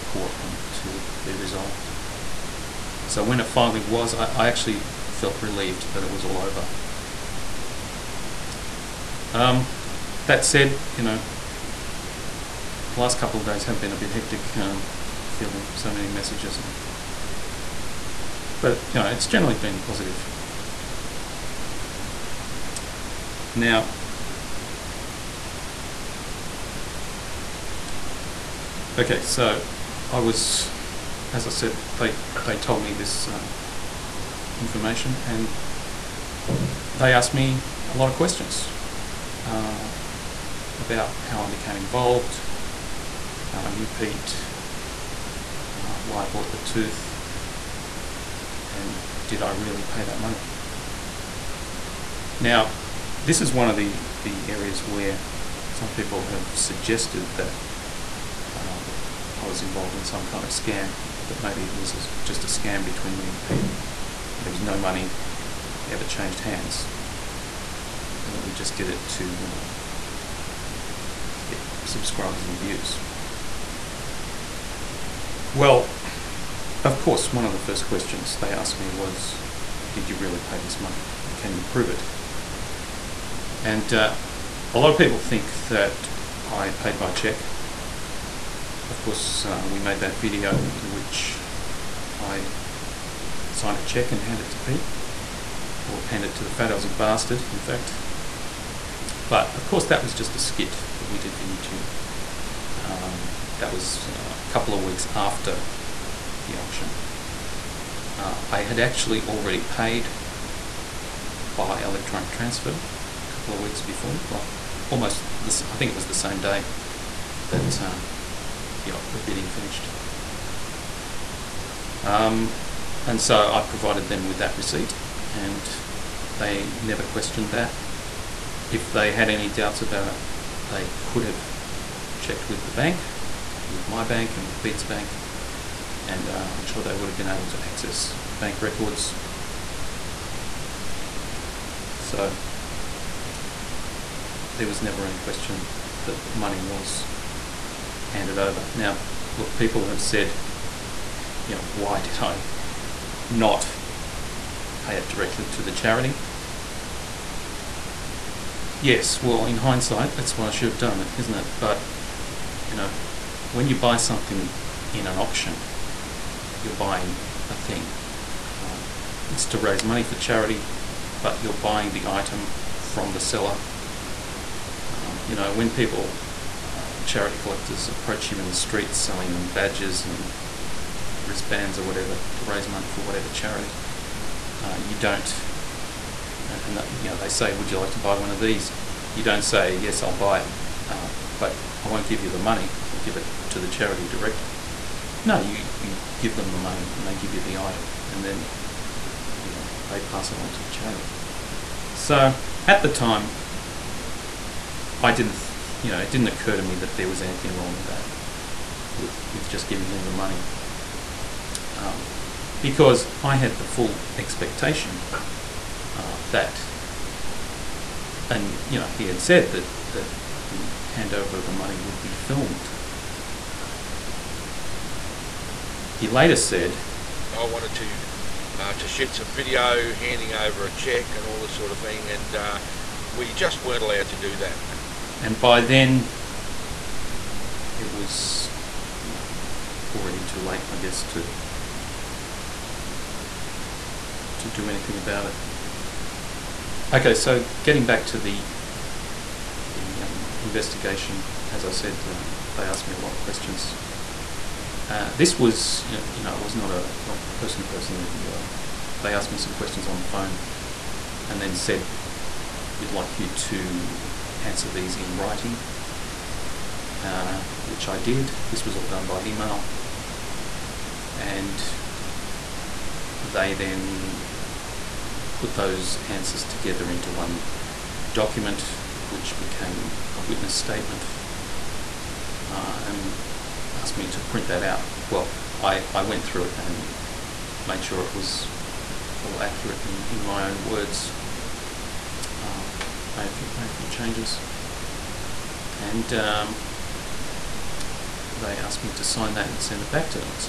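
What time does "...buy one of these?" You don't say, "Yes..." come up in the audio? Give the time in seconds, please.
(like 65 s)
187 s.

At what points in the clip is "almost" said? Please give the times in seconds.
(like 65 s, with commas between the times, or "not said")
114 s.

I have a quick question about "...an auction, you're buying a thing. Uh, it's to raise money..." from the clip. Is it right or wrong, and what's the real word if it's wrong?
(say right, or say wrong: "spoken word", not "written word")
right.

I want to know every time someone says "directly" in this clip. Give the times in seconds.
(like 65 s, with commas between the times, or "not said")
155 s, 194 s.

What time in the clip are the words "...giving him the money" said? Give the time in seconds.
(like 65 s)
209 s.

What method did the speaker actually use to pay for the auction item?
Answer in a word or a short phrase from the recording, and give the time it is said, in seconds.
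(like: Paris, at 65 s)
Electronic transfer, at 111 s.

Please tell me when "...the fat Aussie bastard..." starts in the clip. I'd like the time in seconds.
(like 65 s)
96 s.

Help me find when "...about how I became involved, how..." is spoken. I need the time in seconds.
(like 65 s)
40 s.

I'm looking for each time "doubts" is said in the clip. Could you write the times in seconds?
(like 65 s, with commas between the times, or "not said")
129 s.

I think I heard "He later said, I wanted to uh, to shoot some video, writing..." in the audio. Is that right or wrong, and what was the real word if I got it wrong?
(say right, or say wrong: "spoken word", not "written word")
wrong: "handing", not "writing".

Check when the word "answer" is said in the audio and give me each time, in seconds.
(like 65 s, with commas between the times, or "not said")
264 s, 276 s.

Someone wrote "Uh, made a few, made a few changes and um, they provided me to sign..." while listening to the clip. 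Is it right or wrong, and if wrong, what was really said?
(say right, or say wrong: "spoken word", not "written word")
wrong: "asked", not "provided".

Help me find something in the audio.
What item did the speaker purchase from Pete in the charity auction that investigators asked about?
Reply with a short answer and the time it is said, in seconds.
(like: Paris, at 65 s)
The tooth, at 46 s.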